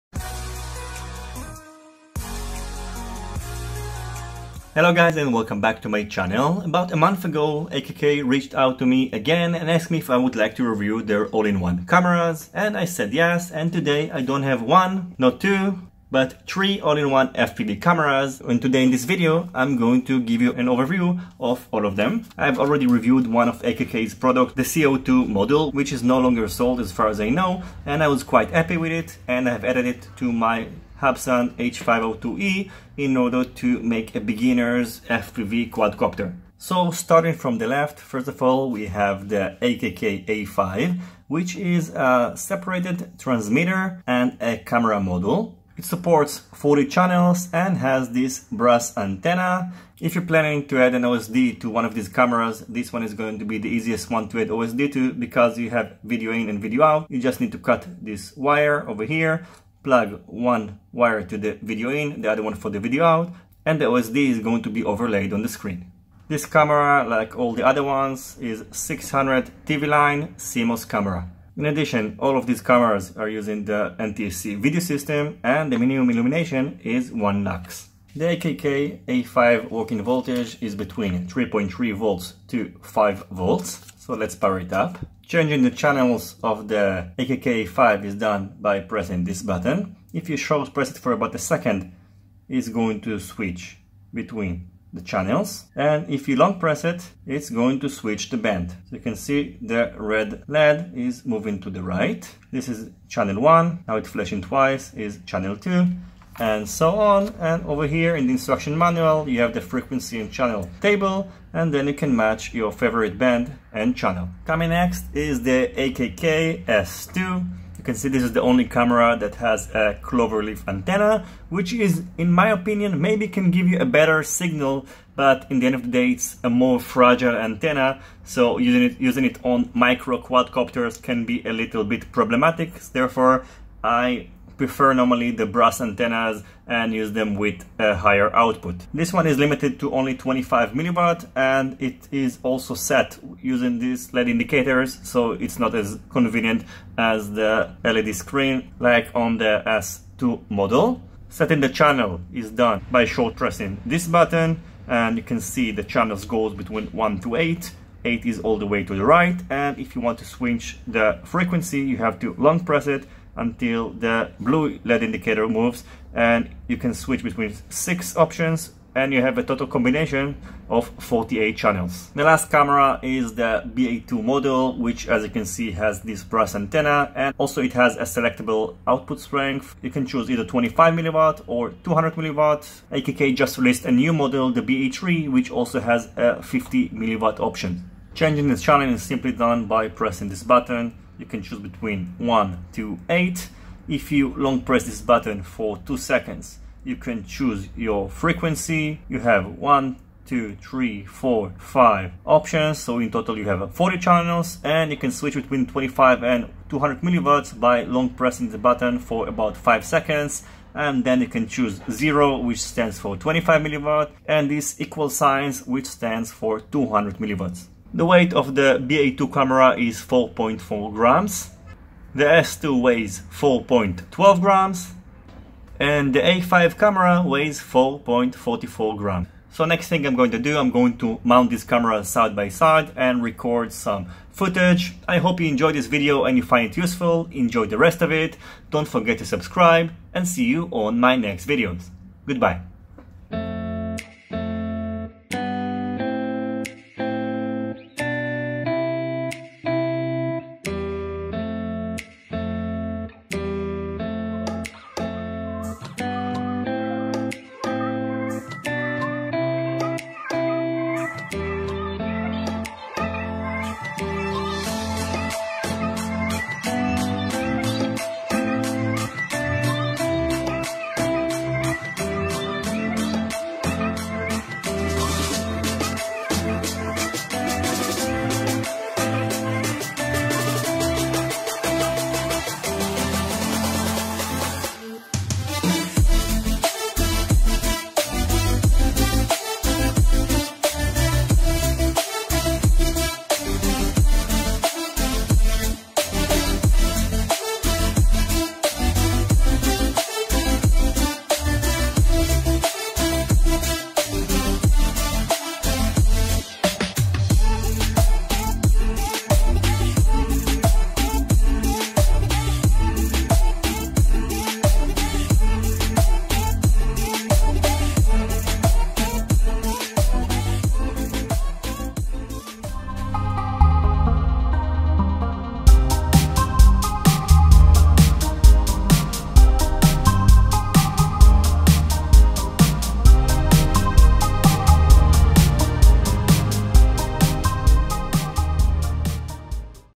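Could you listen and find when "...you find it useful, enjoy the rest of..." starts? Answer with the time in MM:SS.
03:56.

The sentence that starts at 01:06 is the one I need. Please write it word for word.
This camera, like all the other ones, is 600 TV line CMOS camera.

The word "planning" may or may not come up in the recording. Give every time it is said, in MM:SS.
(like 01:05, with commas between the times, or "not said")
00:50.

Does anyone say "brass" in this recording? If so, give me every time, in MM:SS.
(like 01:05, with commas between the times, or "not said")
00:48, 02:15, 02:56.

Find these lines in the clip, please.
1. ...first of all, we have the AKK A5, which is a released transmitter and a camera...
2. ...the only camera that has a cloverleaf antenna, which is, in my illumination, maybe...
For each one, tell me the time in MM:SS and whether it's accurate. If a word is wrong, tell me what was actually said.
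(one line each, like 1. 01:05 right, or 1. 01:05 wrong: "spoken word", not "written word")
1. 00:37 wrong: "separated", not "released"
2. 01:58 wrong: "opinion", not "illumination".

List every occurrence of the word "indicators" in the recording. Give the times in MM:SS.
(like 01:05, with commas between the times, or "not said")
02:24, 02:45.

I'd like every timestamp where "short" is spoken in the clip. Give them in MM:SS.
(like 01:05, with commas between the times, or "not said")
01:30, 02:33.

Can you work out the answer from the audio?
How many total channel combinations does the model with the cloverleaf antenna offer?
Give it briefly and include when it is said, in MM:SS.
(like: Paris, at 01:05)
48, at 02:51.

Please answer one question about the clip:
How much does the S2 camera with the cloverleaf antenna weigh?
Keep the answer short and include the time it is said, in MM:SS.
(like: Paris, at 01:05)
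4.12 grams, at 03:43.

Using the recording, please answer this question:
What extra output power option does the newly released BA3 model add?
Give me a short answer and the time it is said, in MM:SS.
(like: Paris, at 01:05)
50 milliwatt, at 03:06.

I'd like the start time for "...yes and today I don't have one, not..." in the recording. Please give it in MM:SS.
00:13.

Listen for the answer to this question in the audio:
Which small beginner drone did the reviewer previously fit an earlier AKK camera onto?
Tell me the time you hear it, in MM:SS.
00:31.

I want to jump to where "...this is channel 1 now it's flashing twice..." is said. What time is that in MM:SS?
01:42.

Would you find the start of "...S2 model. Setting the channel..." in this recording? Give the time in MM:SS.
02:29.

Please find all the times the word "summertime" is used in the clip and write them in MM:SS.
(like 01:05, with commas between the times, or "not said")
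not said.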